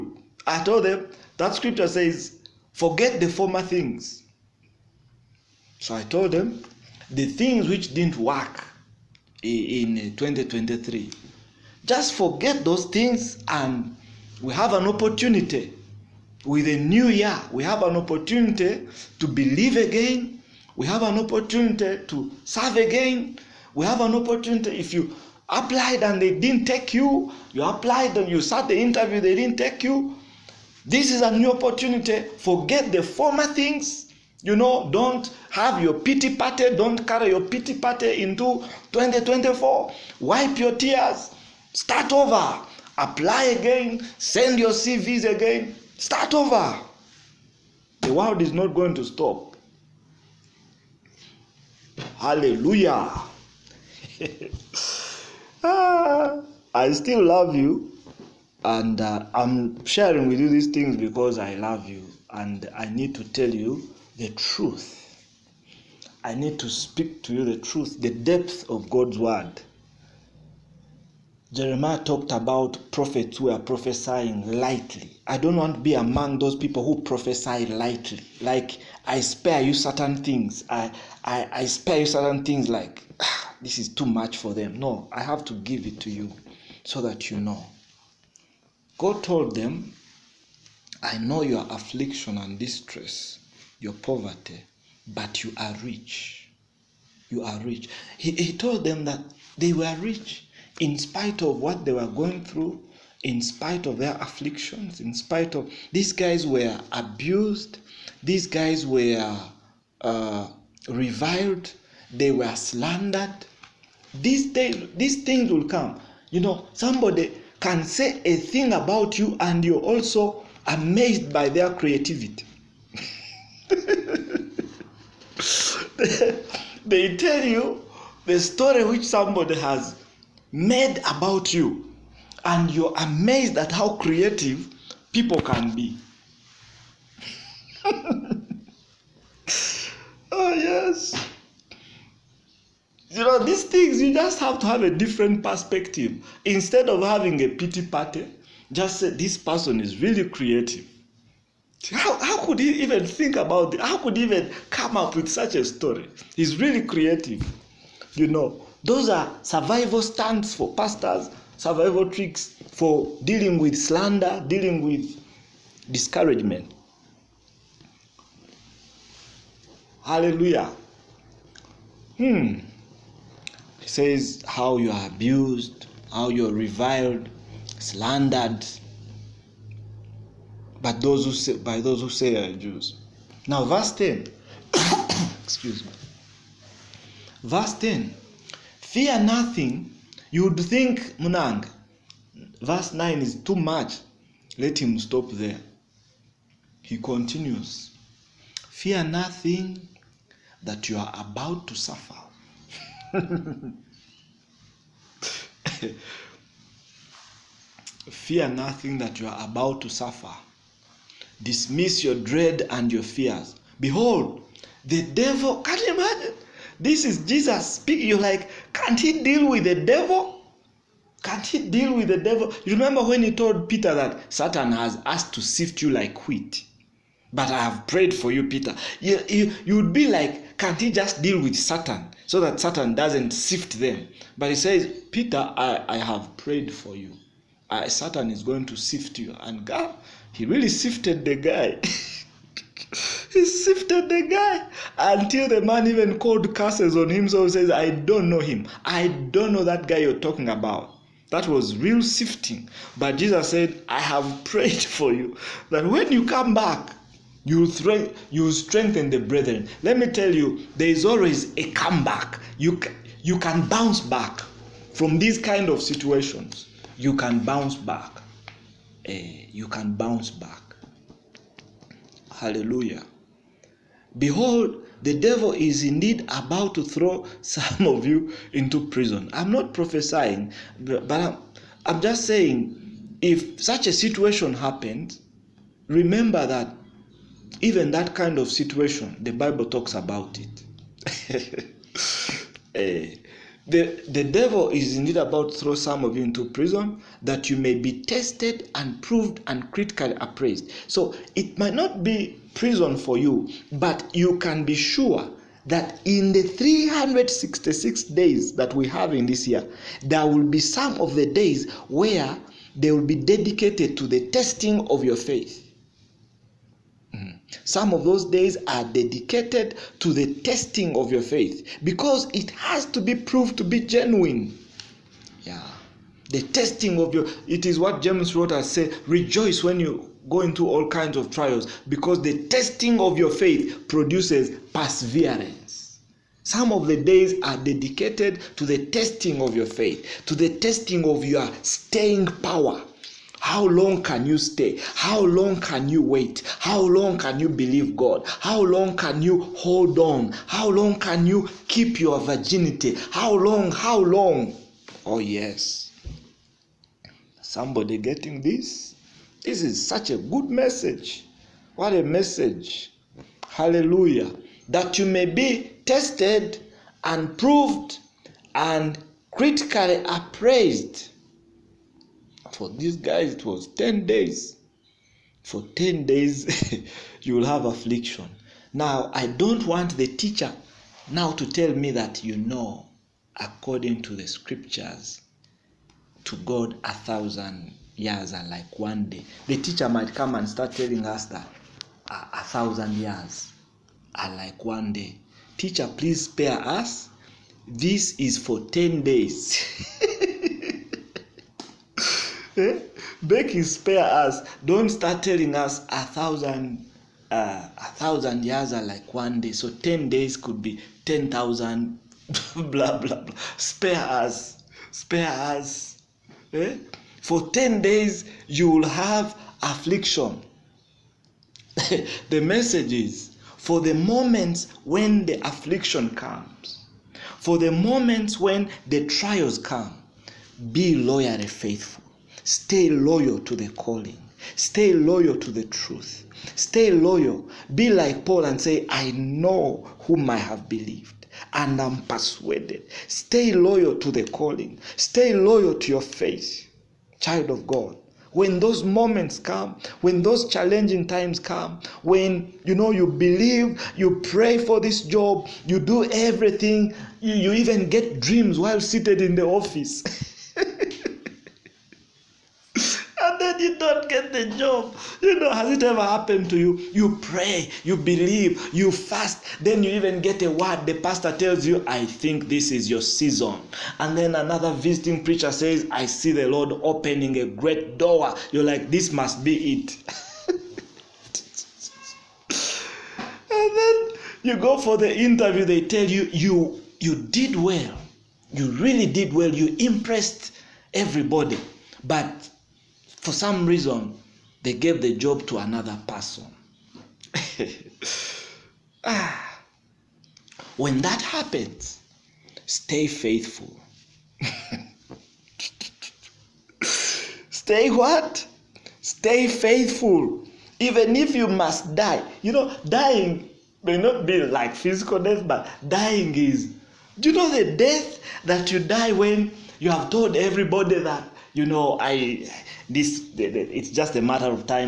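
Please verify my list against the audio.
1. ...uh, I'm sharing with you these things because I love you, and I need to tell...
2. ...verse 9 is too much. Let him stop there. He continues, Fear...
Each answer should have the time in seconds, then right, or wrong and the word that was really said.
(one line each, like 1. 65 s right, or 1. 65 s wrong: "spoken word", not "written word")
1. 59 s right
2. 192 s right.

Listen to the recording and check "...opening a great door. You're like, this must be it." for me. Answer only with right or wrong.
right.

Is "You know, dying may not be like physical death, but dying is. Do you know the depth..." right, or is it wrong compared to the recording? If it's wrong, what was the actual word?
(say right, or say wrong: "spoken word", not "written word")
wrong: "death", not "depth".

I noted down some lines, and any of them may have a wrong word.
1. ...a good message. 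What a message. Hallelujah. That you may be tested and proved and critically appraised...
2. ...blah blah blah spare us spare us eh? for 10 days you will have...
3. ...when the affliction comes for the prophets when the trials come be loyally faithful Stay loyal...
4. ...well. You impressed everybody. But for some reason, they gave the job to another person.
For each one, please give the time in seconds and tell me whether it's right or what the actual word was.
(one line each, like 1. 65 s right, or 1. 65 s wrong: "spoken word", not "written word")
1. 360 s right
2. 412 s right
3. 424 s wrong: "moments", not "prophets"
4. 489 s right.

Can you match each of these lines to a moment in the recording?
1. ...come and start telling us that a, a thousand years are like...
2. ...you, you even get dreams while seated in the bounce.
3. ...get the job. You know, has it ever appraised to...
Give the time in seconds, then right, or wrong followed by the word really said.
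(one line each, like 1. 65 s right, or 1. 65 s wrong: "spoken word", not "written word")
1. 390 s right
2. 457 s wrong: "office", not "bounce"
3. 464 s wrong: "happened", not "appraised".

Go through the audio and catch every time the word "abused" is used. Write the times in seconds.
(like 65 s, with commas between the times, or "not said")
106 s, 175 s.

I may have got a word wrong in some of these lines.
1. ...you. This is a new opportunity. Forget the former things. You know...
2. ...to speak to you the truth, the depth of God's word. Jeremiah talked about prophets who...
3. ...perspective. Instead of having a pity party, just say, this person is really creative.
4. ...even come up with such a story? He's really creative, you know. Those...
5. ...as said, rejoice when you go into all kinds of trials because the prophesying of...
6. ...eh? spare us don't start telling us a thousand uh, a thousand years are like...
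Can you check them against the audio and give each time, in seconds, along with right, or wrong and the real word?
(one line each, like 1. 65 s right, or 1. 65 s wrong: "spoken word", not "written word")
1. 29 s right
2. 66 s right
3. 145 s right
4. 154 s right
5. 328 s wrong: "testing", not "prophesying"
6. 402 s right.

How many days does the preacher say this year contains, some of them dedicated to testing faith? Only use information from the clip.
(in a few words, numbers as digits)
366.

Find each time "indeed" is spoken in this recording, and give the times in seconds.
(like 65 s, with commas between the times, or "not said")
275 s, 294 s.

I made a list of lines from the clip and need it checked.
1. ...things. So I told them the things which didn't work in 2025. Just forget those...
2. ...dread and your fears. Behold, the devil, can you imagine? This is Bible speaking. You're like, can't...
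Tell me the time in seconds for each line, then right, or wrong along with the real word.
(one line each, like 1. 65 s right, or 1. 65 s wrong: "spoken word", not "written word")
1. 3 s wrong: "2023", not "2025"
2. 212 s wrong: "Jesus", not "Bible".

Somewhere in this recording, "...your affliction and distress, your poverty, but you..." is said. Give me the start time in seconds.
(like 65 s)
91 s.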